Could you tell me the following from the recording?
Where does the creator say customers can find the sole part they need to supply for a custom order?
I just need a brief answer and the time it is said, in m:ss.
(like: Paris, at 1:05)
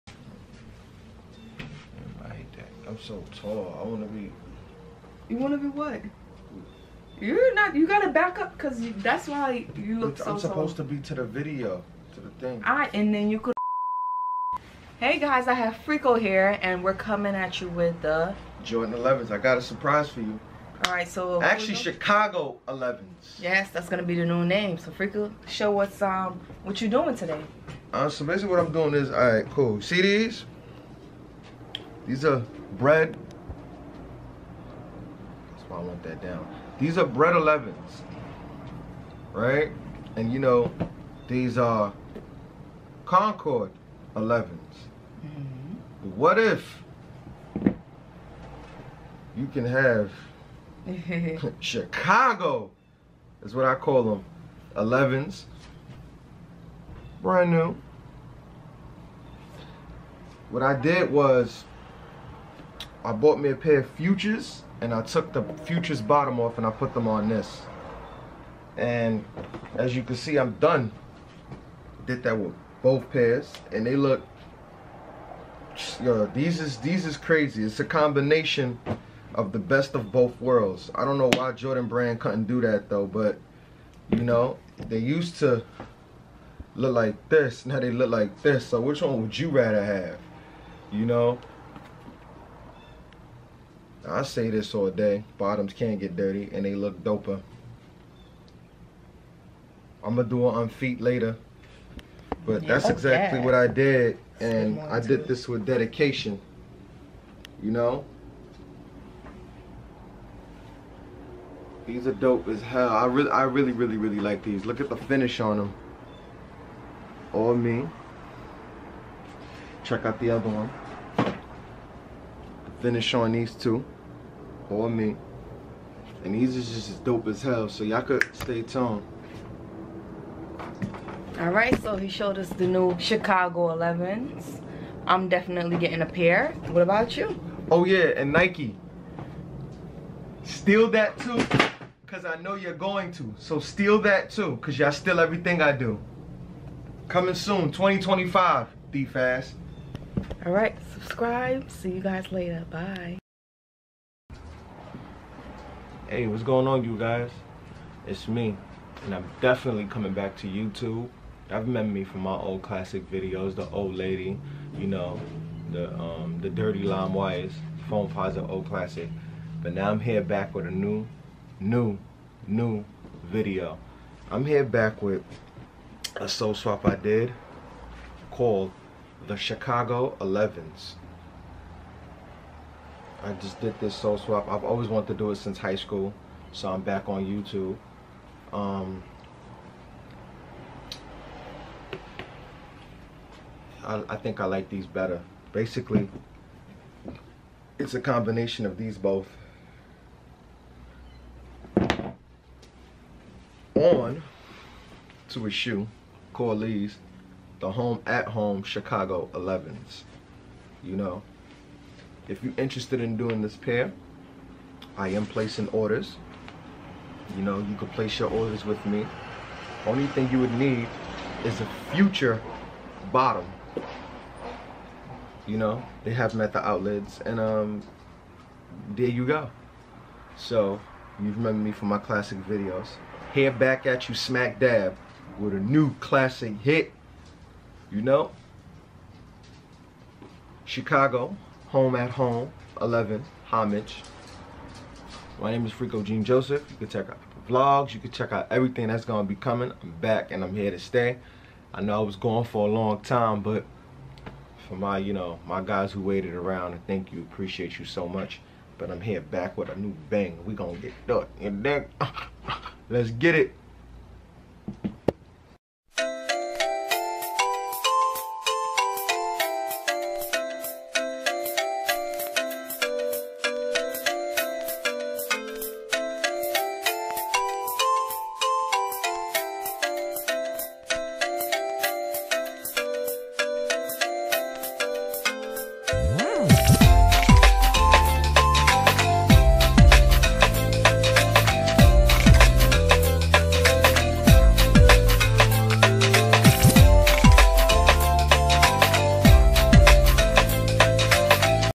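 the outlets, at 3:46.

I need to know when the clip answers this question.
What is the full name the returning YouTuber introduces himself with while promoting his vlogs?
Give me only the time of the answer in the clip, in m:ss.
4:05.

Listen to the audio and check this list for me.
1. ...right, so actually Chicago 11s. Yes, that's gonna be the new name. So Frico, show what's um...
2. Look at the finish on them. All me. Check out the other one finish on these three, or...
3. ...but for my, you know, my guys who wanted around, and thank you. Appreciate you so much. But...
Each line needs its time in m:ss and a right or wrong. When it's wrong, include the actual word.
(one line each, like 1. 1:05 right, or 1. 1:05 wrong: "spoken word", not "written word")
1. 0:20 right
2. 1:54 wrong: "two", not "three"
3. 4:13 wrong: "waited", not "wanted".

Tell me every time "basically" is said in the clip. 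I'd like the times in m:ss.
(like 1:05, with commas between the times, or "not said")
0:28, 3:15.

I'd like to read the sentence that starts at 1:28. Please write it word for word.
So which one would you rather have?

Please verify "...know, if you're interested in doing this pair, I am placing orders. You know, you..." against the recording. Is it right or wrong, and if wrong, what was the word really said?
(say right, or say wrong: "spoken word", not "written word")
right.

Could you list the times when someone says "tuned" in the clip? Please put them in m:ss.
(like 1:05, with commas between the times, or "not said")
2:08.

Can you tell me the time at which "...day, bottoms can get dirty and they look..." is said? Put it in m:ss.
1:34.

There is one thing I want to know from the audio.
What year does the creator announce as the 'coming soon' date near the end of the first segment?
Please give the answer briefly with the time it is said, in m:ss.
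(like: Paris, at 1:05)
2025, at 2:27.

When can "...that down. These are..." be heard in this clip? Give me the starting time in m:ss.
0:36.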